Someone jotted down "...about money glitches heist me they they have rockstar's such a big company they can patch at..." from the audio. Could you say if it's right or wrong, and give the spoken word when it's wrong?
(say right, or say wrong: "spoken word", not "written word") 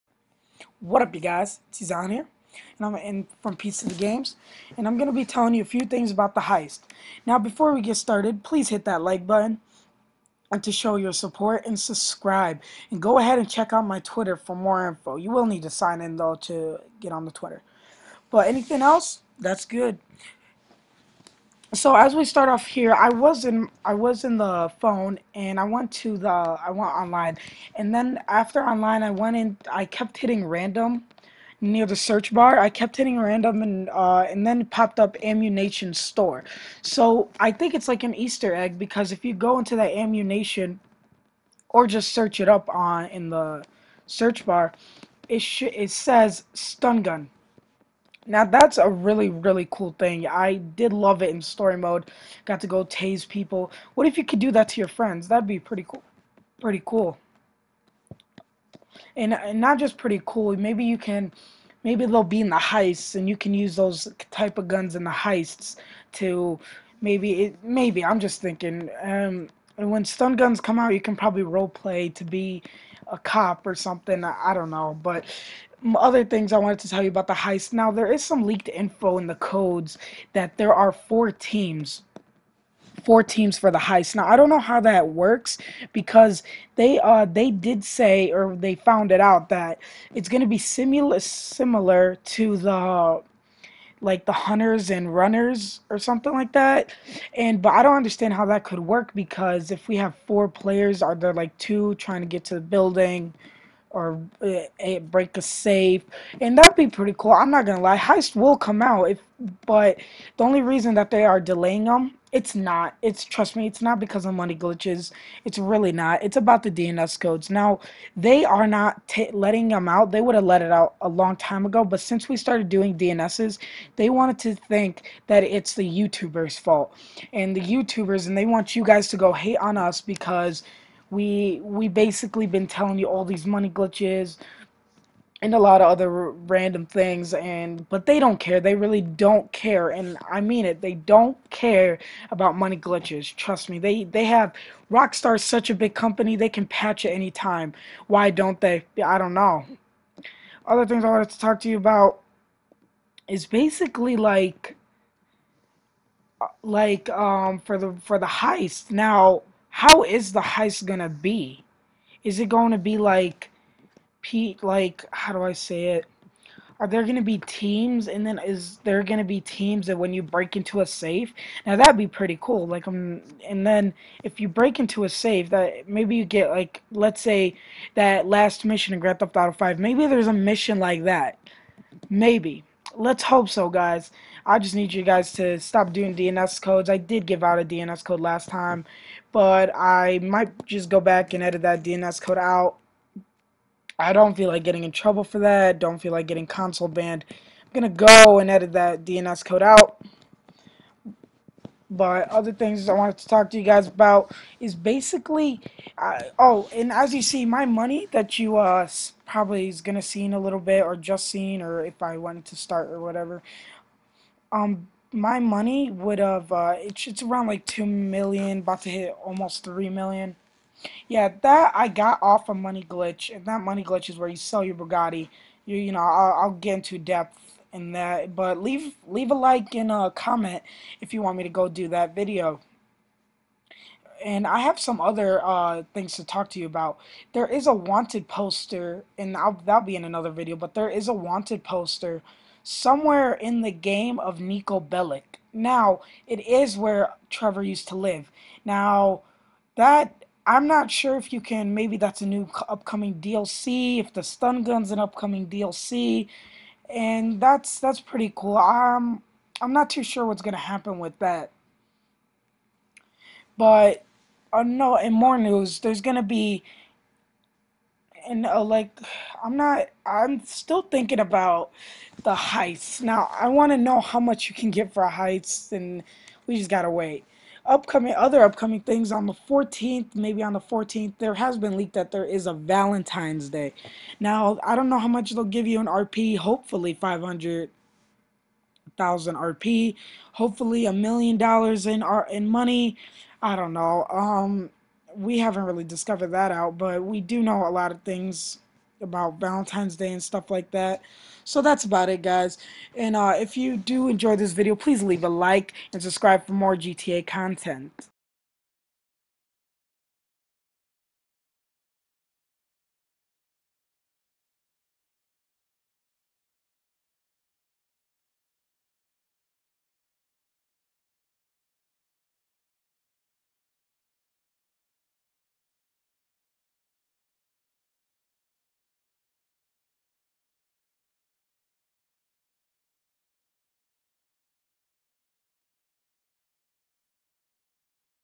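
wrong: "trust", not "heist".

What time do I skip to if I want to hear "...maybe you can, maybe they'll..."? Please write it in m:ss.
1:00.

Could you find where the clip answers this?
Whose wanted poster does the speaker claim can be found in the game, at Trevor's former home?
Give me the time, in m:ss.
4:04.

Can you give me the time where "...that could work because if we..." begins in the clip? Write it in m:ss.
1:38.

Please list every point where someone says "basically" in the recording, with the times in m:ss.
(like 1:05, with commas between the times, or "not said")
2:11, 2:33, 3:24.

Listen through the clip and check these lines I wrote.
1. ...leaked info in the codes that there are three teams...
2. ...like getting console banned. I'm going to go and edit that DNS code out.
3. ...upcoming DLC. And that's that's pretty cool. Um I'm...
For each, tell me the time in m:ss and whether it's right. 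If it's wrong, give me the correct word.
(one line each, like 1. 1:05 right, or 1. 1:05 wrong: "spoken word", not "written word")
1. 1:18 wrong: "four", not "three"
2. 3:16 right
3. 4:14 right.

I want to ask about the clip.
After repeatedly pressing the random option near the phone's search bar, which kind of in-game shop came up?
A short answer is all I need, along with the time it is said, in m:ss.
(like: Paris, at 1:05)
Ammunition store, at 0:35.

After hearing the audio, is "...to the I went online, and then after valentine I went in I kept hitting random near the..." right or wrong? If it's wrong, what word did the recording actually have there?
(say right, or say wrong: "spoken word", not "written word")
wrong: "online", not "valentine".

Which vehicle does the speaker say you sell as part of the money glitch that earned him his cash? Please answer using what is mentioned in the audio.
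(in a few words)
Bugatti.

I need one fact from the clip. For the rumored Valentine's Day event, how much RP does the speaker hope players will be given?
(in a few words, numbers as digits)
500,000 RP.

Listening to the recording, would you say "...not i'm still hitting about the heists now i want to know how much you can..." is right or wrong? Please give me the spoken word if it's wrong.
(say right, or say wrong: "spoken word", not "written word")
wrong: "thinking", not "hitting".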